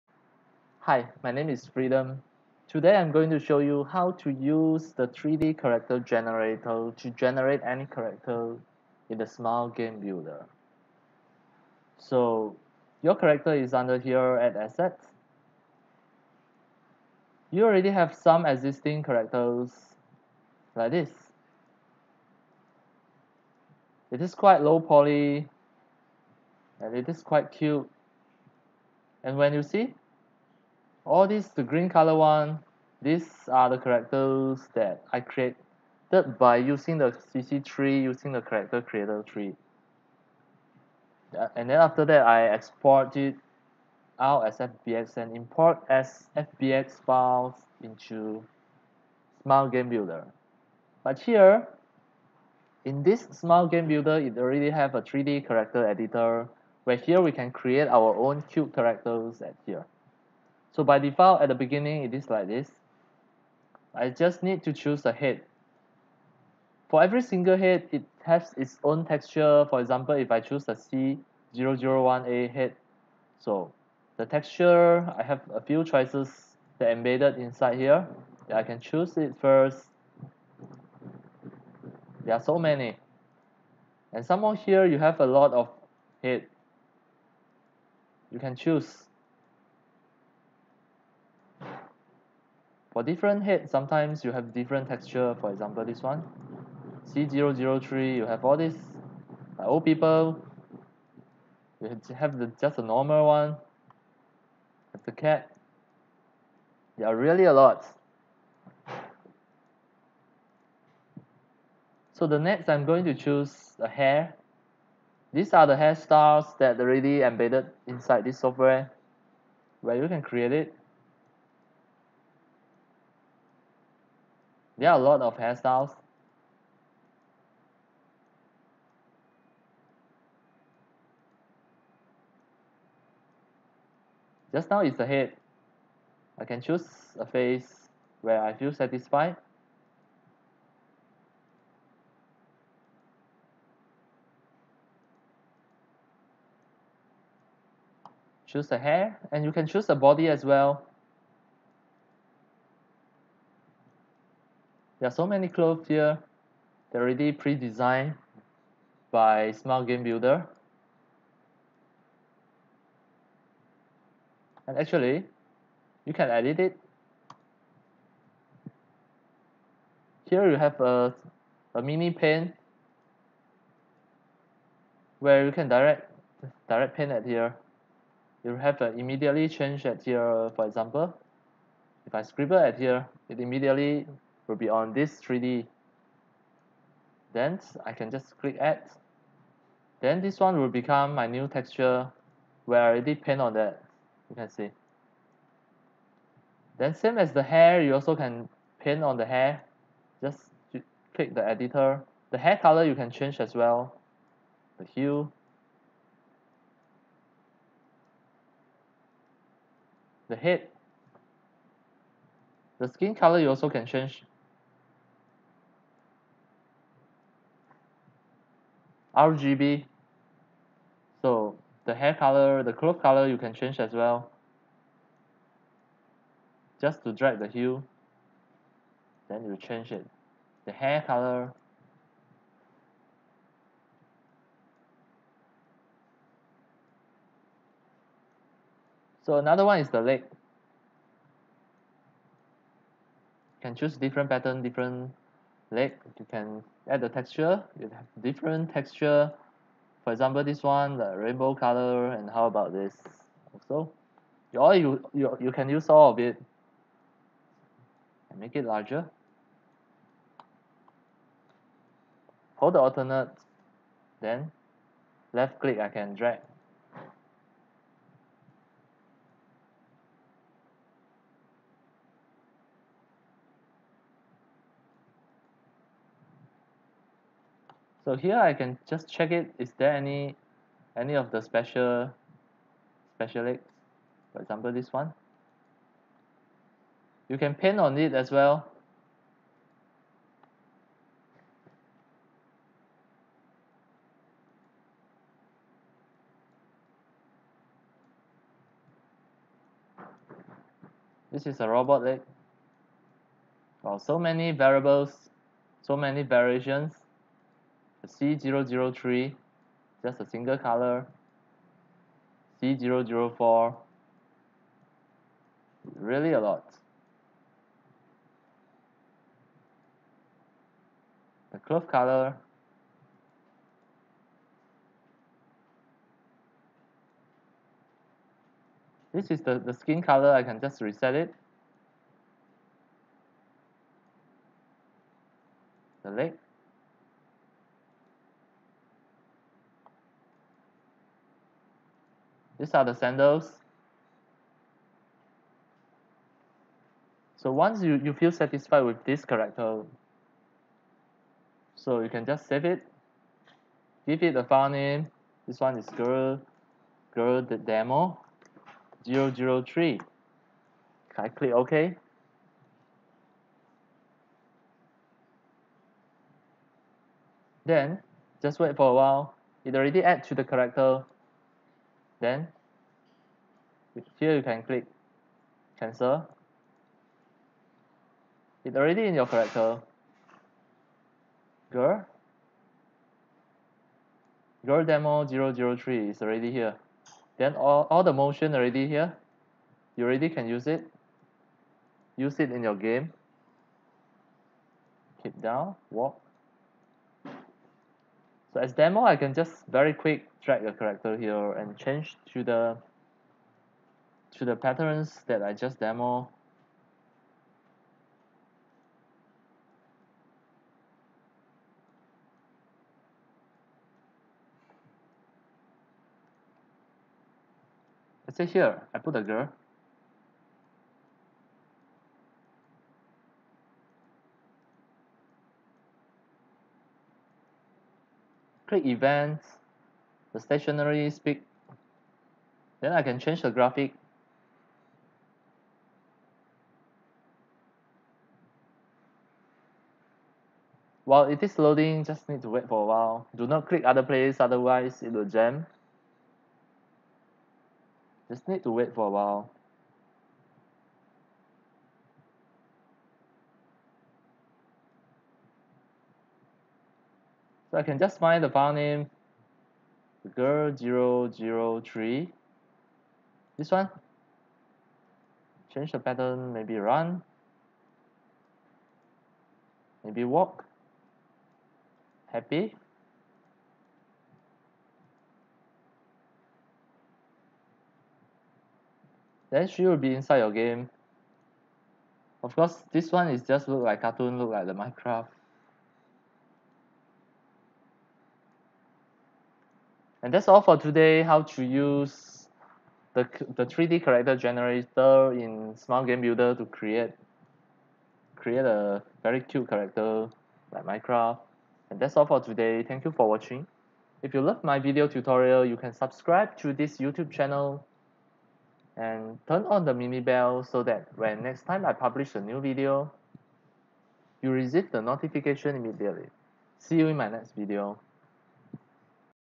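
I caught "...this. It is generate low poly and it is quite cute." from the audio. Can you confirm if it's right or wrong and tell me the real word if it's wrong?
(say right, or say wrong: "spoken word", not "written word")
wrong: "quite", not "generate".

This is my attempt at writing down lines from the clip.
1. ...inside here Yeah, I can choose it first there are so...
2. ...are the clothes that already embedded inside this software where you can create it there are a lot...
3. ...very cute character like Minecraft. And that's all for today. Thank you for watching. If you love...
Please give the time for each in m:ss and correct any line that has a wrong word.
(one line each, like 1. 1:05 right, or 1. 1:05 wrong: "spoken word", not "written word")
1. 1:17 right
2. 1:55 wrong: "hairstyles", not "clothes"
3. 8:19 right.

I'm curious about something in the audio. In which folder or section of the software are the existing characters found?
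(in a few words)
Assets.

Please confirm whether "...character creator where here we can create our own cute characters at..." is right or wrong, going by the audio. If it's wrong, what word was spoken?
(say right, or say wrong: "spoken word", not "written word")
wrong: "editor", not "creator".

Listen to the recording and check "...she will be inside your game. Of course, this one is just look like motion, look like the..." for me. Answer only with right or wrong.
wrong.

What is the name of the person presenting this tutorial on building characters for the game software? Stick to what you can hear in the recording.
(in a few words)
Freedom.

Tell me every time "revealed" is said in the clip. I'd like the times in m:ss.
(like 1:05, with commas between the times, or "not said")
not said.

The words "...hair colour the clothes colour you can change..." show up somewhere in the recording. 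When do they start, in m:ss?
3:41.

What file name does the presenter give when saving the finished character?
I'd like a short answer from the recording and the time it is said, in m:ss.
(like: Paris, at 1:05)
girl demo 003, at 5:57.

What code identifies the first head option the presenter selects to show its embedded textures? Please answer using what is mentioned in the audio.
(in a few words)
C001A.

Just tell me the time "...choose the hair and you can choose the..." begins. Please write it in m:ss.
2:28.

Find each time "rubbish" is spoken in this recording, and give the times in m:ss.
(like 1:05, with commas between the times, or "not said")
not said.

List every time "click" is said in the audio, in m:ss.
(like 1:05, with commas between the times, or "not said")
3:08, 3:21, 4:25, 6:01, 6:14, 7:08, 7:23.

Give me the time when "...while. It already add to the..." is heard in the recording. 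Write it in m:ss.
6:08.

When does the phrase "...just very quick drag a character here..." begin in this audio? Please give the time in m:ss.
6:39.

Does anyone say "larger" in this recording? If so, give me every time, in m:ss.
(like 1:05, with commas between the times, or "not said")
4:18.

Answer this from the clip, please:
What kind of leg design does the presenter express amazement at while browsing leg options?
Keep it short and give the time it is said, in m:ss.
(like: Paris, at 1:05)
robot leg, at 5:01.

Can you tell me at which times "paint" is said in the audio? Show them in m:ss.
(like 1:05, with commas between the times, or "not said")
3:13, 3:18, 4:47.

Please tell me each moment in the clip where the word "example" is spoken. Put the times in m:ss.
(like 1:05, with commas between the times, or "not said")
1:09, 1:35, 3:00, 4:10, 4:44.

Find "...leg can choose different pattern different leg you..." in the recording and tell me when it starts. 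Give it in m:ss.
4:00.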